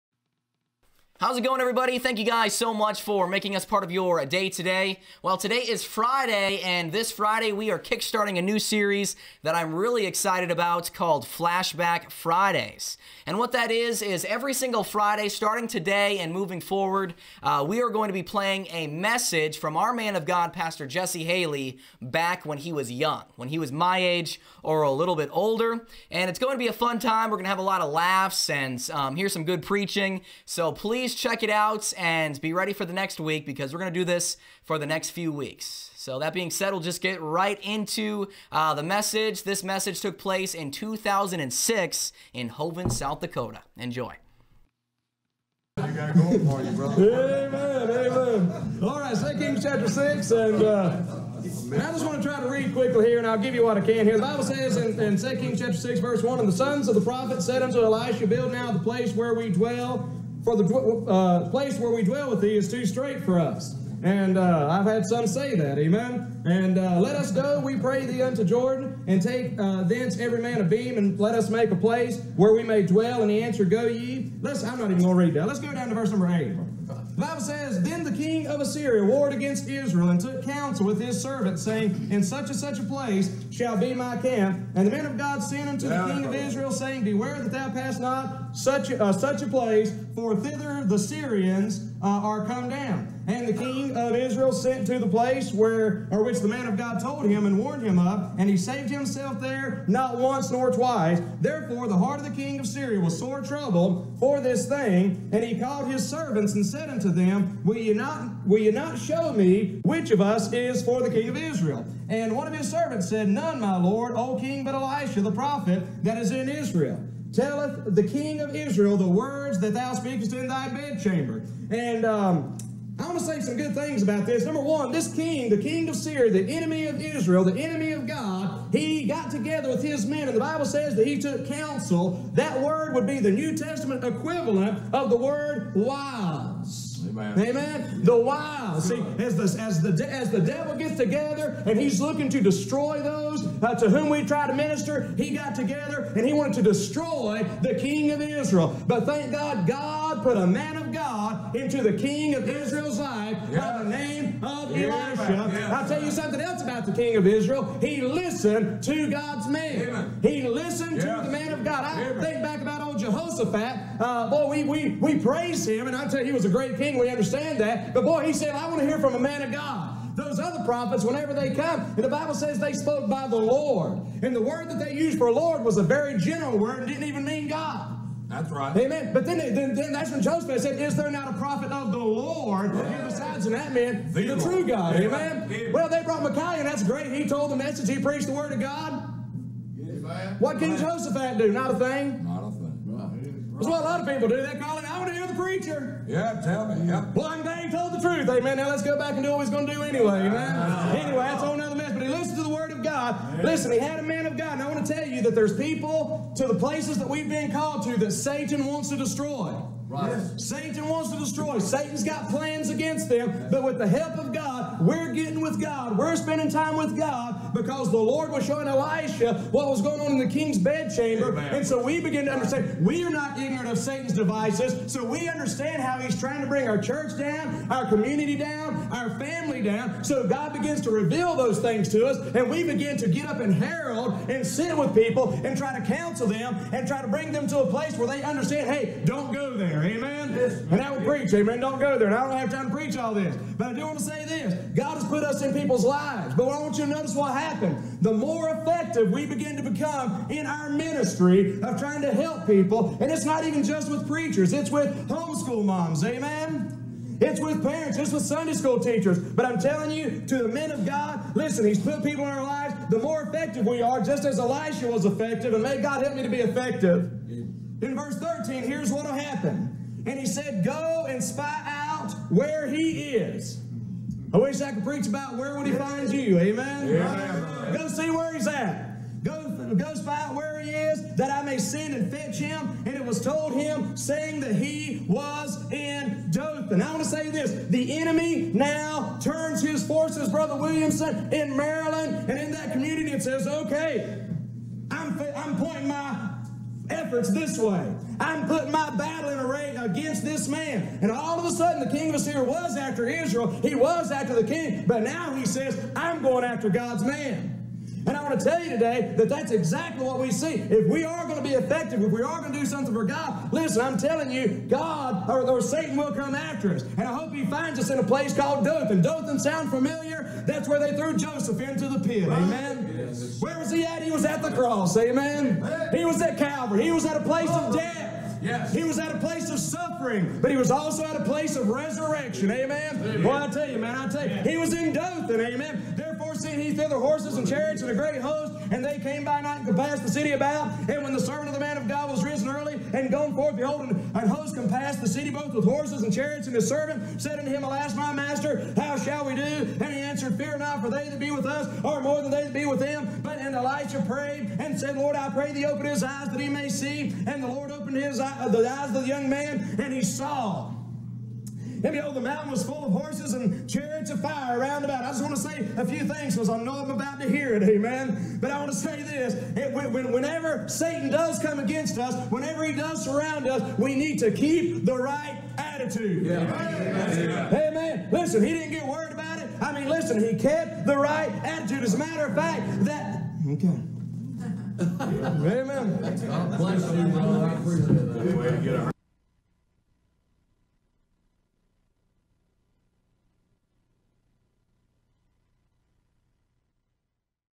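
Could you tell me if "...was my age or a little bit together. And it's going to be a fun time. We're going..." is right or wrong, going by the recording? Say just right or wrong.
wrong.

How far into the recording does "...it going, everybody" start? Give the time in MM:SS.
00:01.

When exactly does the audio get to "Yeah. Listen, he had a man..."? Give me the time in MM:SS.
03:23.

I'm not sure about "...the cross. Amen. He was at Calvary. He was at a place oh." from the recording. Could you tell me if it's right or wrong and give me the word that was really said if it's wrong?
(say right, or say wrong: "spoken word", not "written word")
right.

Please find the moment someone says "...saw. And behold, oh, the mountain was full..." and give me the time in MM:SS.
06:00.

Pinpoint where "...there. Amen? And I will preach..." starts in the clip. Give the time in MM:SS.
03:59.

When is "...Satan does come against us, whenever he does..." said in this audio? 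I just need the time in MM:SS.
06:10.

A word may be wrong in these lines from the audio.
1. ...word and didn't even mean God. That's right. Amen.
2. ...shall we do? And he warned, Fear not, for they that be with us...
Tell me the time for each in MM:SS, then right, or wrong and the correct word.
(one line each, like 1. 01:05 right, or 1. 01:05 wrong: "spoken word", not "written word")
1. 02:56 right
2. 05:48 wrong: "answered", not "warned".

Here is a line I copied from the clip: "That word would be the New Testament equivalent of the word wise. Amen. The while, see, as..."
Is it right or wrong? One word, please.
right.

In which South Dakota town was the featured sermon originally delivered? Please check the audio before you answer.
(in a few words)
Hoven.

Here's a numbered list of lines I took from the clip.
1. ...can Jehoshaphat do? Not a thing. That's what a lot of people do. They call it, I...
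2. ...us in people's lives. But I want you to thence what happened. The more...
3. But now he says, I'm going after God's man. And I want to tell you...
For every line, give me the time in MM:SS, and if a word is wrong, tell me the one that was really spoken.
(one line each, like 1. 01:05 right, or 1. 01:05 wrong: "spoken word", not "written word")
1. 03:10 right
2. 04:05 wrong: "notice", not "thence"
3. 05:04 right.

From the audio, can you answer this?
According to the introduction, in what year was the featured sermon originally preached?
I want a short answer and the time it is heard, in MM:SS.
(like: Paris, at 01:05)
2006, at 00:40.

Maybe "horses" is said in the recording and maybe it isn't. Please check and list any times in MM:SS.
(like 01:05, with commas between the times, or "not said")
05:36, 05:45, 06:02.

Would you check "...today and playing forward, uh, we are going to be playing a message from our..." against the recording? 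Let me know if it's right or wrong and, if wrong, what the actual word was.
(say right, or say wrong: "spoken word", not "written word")
wrong: "moving", not "playing".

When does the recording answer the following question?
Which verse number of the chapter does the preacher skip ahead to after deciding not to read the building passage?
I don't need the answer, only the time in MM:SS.
01:15.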